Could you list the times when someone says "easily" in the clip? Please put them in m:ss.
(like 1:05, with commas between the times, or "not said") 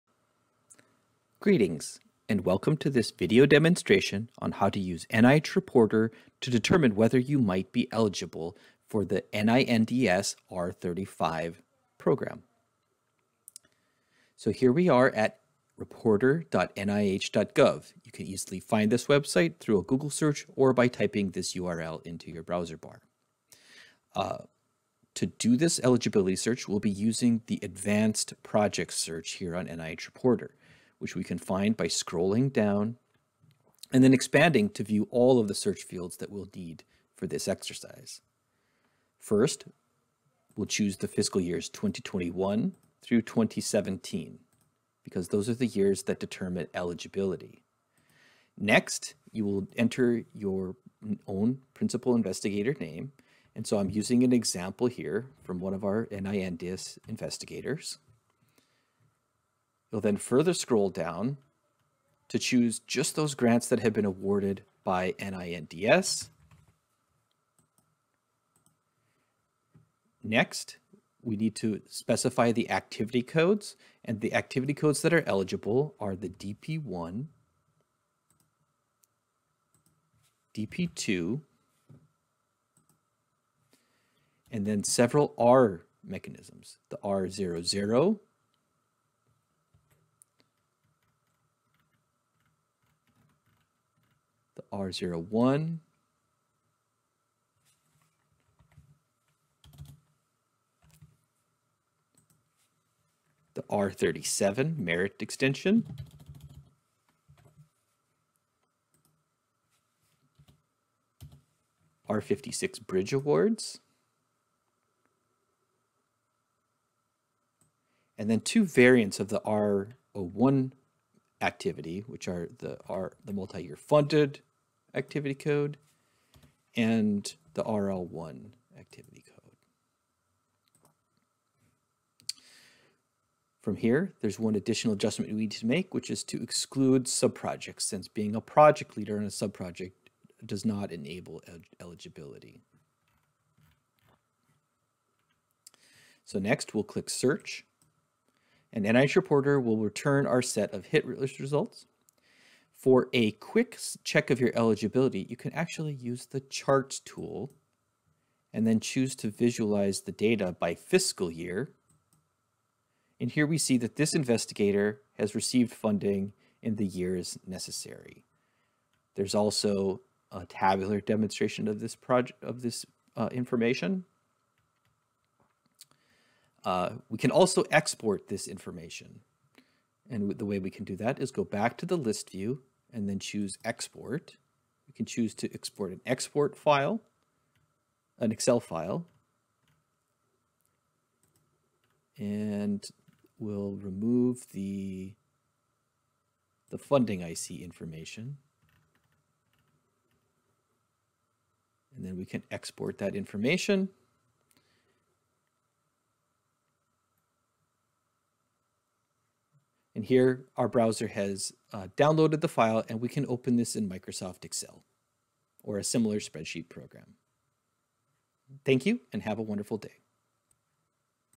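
0:18.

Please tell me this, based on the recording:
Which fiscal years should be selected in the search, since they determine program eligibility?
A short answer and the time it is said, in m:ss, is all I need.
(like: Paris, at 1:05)
2021 through 2017, at 0:41.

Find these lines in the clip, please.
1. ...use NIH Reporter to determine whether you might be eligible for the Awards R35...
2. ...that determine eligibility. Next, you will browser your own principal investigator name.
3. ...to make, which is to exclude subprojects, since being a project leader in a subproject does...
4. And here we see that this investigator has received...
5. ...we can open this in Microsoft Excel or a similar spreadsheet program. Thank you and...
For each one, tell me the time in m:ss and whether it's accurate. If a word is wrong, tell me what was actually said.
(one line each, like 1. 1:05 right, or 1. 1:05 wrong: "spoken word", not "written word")
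1. 0:04 wrong: "NINDS", not "Awards"
2. 0:46 wrong: "enter", not "browser"
3. 2:15 right
4. 2:43 right
5. 3:32 right.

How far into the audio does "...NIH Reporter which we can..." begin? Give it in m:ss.
0:29.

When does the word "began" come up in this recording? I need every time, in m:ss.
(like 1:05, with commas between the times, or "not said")
not said.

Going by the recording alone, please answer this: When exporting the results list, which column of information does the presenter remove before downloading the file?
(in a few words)
funding IC information.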